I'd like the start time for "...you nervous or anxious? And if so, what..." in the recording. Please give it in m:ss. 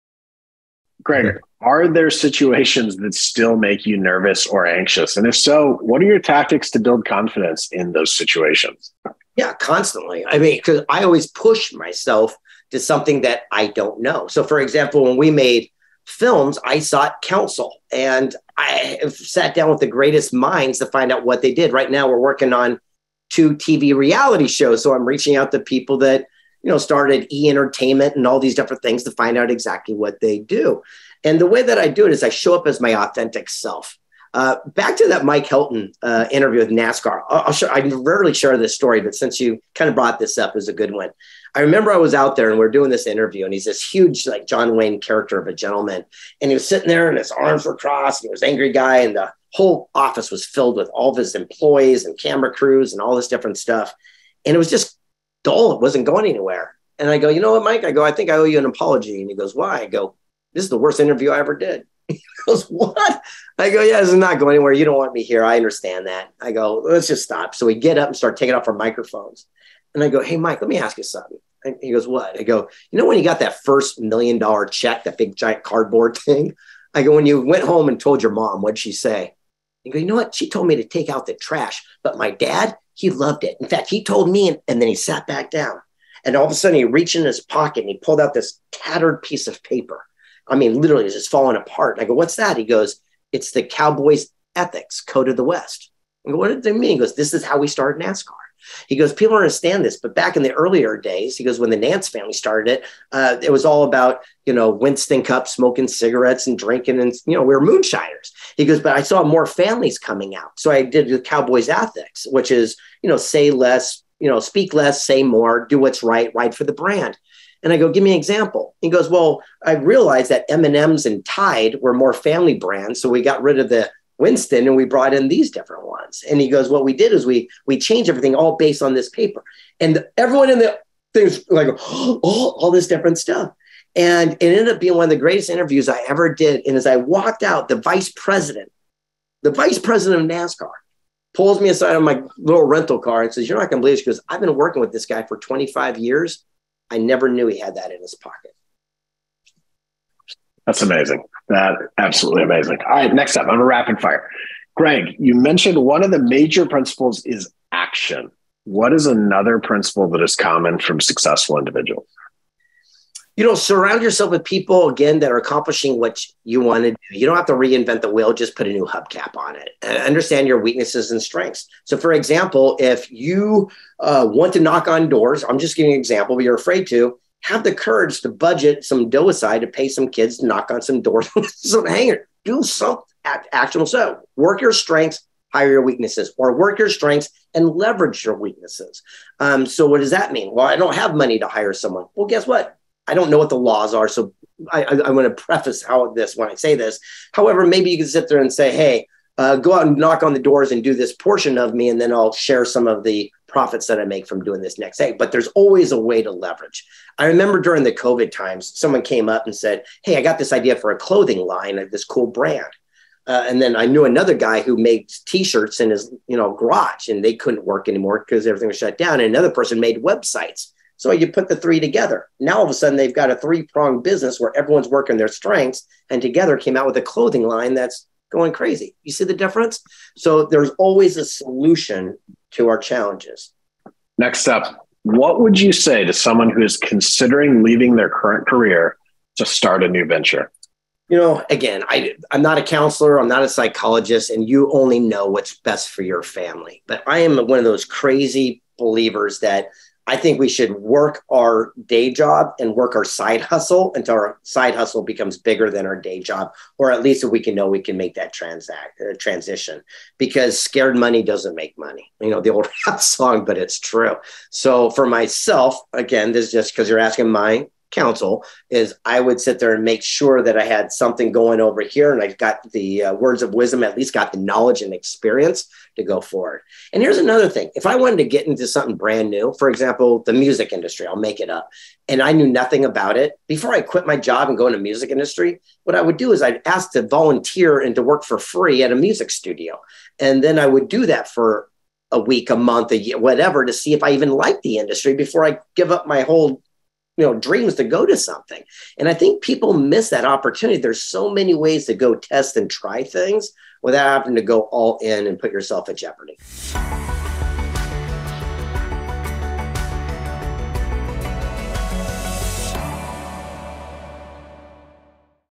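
0:03.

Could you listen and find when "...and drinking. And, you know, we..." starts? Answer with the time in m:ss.
1:46.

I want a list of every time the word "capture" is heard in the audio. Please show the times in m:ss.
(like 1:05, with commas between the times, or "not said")
not said.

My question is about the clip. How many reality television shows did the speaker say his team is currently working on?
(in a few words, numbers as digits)
2.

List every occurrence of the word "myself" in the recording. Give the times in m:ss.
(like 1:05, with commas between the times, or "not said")
0:11, 4:25.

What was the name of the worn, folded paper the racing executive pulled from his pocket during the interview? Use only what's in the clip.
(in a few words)
Cowboys Ethics Code of the West.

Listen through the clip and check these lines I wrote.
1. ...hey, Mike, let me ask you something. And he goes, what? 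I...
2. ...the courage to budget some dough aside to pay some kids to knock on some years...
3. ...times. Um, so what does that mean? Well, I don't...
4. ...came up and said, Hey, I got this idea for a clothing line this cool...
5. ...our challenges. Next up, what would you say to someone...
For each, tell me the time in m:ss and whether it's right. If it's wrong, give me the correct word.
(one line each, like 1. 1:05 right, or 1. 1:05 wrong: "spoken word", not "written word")
1. 1:10 right
2. 2:57 wrong: "doors", not "years"
3. 3:08 wrong: "weaknesses", not "times"
4. 3:29 right
5. 3:52 right.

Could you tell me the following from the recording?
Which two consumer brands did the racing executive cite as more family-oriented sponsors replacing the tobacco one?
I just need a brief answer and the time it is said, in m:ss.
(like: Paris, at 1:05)
M&Ms and Tide, at 2:00.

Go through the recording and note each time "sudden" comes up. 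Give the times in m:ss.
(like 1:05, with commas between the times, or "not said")
1:26, 3:42.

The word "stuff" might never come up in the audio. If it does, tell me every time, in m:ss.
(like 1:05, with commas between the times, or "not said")
0:53, 2:13.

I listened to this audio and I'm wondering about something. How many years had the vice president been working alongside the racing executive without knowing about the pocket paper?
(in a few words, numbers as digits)
25.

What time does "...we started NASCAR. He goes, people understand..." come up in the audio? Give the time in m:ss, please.
1:37.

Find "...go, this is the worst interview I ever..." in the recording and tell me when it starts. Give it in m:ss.
0:59.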